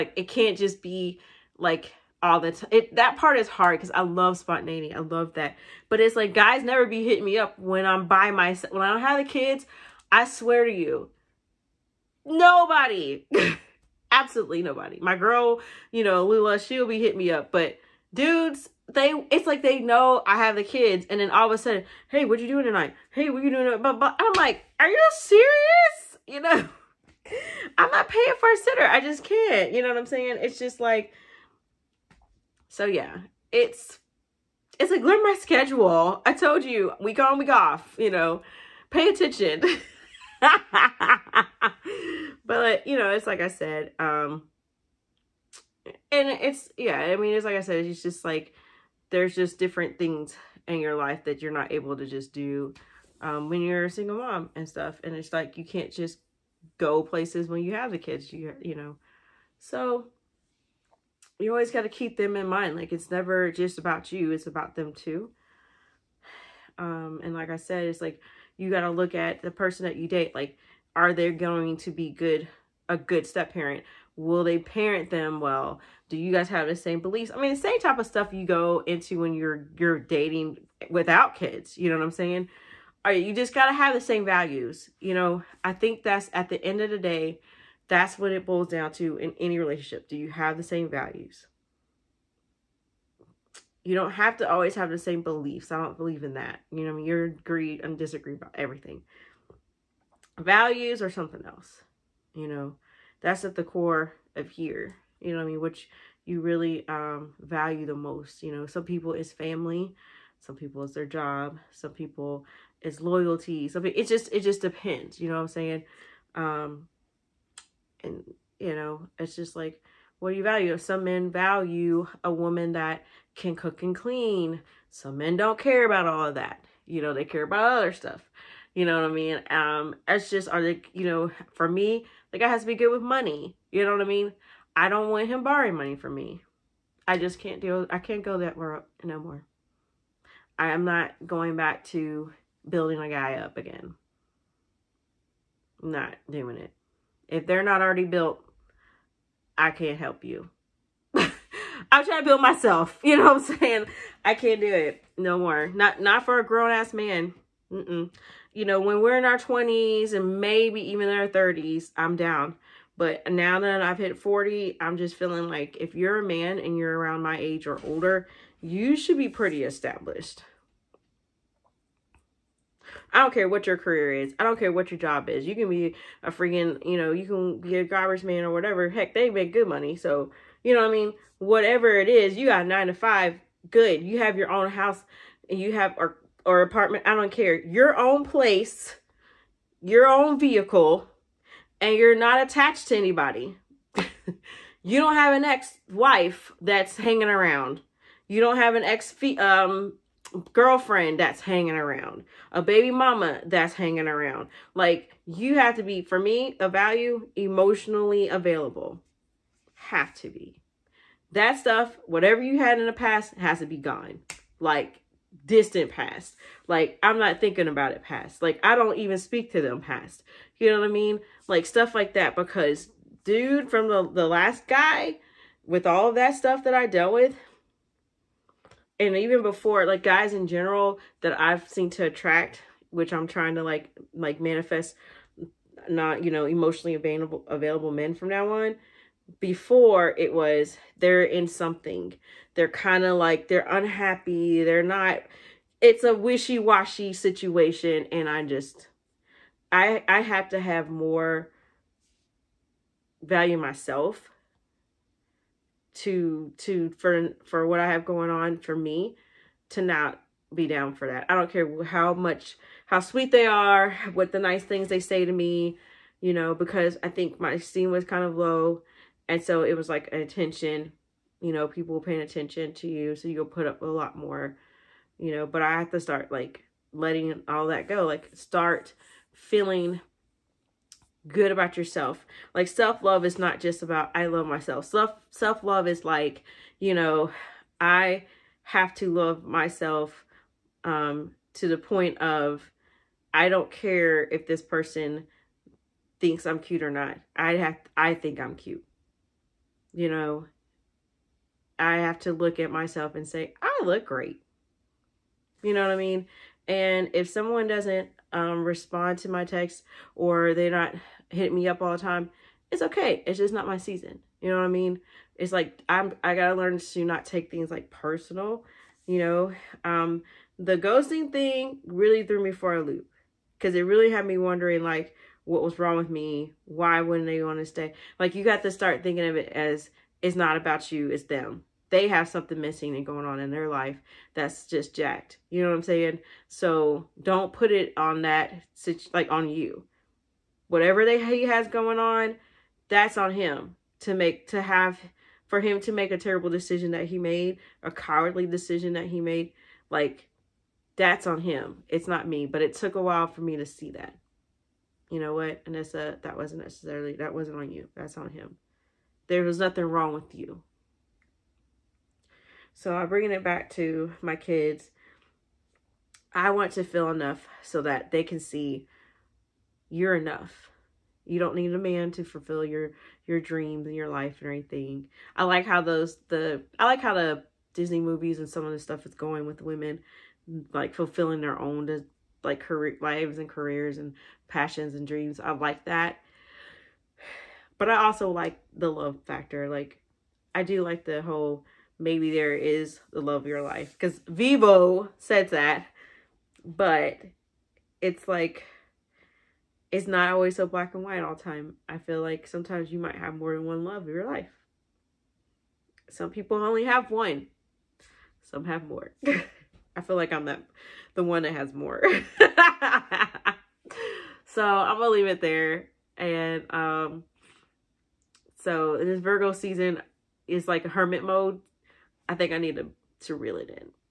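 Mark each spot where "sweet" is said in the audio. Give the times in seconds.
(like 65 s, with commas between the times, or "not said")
262 s.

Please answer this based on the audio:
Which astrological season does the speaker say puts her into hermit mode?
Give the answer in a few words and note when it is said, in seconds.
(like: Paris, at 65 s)
Virgo season, at 419 s.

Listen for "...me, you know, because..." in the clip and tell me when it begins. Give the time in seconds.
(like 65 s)
265 s.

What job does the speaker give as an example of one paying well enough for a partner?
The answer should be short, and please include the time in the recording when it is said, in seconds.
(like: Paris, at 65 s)
garbage man, at 177 s.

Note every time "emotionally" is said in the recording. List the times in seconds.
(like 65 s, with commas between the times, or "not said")
207 s, 236 s.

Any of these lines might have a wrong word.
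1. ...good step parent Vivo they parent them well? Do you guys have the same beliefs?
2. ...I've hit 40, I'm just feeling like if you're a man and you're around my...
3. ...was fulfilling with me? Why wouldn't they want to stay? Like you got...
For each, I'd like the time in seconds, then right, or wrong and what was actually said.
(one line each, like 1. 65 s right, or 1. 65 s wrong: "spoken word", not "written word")
1. 72 s wrong: "Will", not "Vivo"
2. 163 s right
3. 325 s wrong: "wrong", not "fulfilling".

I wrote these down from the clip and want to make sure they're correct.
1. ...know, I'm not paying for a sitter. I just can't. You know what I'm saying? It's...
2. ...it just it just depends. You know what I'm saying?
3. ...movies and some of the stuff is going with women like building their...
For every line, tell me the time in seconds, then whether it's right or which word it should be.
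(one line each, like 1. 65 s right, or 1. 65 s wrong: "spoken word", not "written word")
1. 26 s right
2. 113 s right
3. 377 s wrong: "fulfilling", not "building".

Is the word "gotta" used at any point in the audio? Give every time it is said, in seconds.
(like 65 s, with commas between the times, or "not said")
83 s, 316 s.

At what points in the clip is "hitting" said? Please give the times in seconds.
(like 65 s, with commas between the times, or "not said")
7 s, 16 s, 311 s.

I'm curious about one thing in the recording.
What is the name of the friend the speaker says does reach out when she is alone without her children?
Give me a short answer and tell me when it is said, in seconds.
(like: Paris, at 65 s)
Lula, at 16 s.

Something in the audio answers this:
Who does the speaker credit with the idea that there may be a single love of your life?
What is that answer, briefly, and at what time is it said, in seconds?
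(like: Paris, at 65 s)
Vivo, at 394 s.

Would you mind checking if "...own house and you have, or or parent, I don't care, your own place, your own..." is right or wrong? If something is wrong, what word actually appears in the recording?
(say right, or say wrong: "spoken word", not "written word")
wrong: "apartment", not "parent".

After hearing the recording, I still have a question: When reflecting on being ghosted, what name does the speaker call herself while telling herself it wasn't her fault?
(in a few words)
Anissa.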